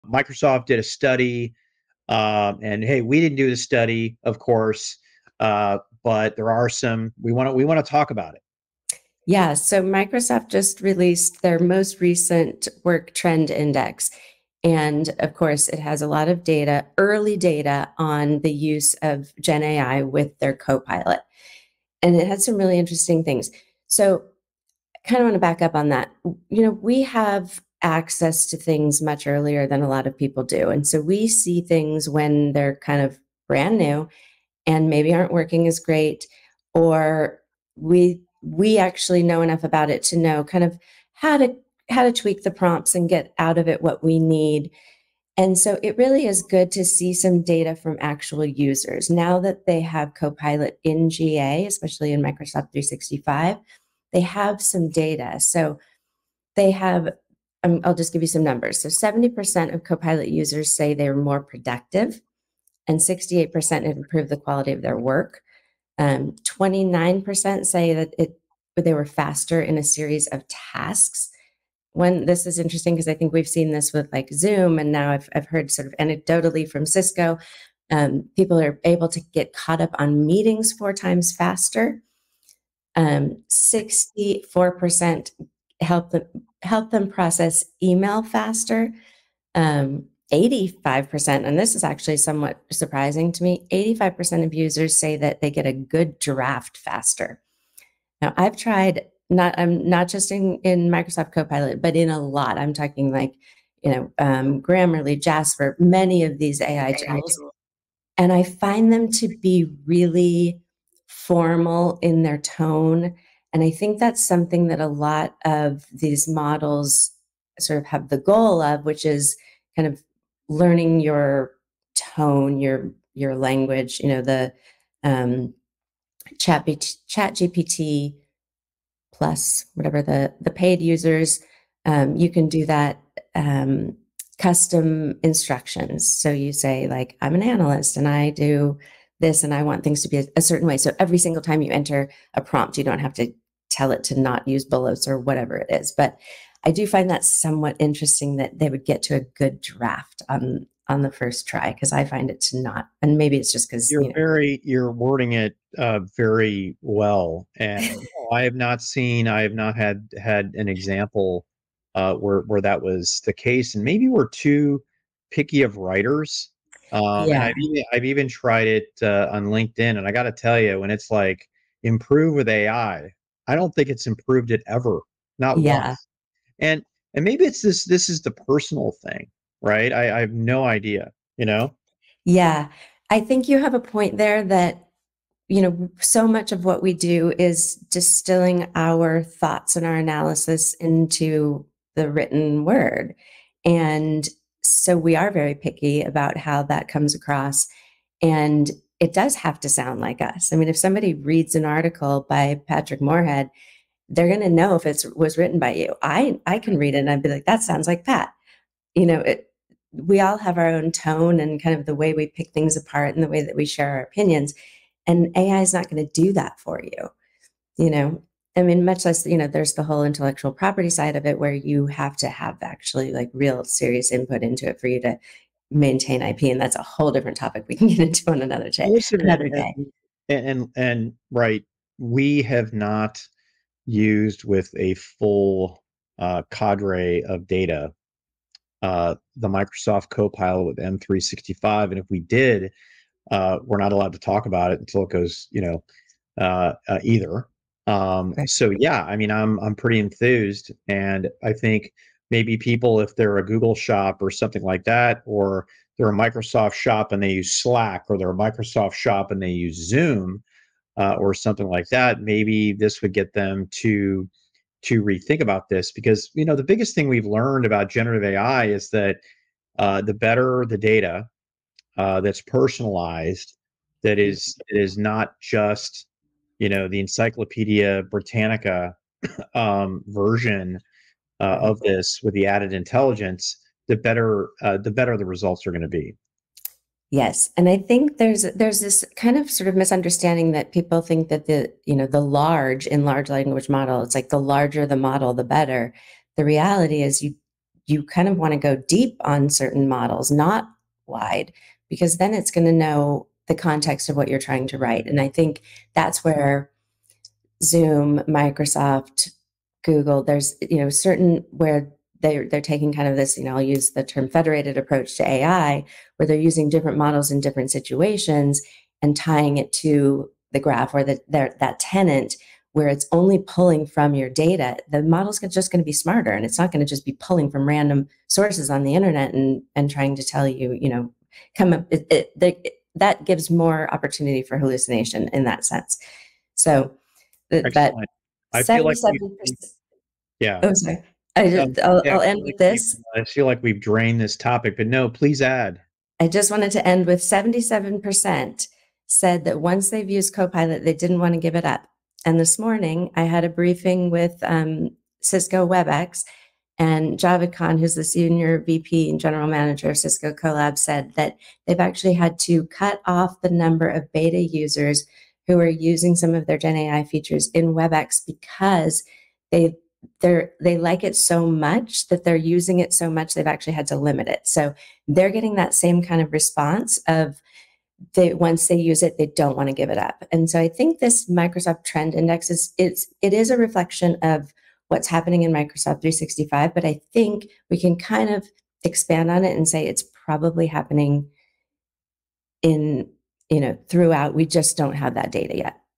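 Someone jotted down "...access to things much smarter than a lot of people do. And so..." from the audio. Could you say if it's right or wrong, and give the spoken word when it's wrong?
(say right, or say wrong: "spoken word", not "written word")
wrong: "earlier", not "smarter".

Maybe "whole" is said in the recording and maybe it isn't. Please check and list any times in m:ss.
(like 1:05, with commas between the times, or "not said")
3:39, 3:46.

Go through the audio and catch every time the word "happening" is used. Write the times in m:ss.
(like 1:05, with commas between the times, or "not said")
6:25, 6:30.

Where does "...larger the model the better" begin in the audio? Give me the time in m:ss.
4:54.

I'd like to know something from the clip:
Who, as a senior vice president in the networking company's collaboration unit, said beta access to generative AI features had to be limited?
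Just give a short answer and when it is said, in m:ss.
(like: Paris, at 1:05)
Javed Khan, at 5:57.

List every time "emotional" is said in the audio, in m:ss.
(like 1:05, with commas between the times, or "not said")
not said.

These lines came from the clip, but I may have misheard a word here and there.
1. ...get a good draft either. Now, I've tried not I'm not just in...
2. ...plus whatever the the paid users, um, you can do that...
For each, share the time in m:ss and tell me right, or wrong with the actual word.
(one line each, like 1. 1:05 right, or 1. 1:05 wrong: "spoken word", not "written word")
1. 1:35 wrong: "faster", not "either"
2. 2:09 right.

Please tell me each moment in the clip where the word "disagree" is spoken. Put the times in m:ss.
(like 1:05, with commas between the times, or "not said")
not said.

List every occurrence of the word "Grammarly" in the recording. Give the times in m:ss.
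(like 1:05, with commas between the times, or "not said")
1:44.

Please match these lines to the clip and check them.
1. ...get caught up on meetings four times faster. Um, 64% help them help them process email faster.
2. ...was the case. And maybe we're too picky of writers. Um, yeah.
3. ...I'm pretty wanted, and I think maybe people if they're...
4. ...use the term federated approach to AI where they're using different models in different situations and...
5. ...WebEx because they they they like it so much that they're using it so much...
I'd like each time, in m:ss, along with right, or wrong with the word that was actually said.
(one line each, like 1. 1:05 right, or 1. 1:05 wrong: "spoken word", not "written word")
1. 1:19 right
2. 2:42 right
3. 4:09 wrong: "enthused", not "wanted"
4. 5:13 right
5. 6:07 right.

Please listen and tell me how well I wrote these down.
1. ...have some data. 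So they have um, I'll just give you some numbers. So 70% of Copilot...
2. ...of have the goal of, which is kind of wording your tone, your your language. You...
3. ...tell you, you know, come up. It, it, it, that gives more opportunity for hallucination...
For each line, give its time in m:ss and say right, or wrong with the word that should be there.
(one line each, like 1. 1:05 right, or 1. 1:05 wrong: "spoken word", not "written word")
1. 0:54 right
2. 1:57 wrong: "learning", not "wording"
3. 5:30 right.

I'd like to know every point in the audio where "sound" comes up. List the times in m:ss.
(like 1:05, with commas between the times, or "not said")
3:19, 3:27.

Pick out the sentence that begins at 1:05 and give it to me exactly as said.
Um, 29% say that it they were faster in a series of tasks.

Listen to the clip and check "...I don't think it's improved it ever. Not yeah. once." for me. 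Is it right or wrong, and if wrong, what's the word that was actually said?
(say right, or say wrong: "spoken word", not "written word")
right.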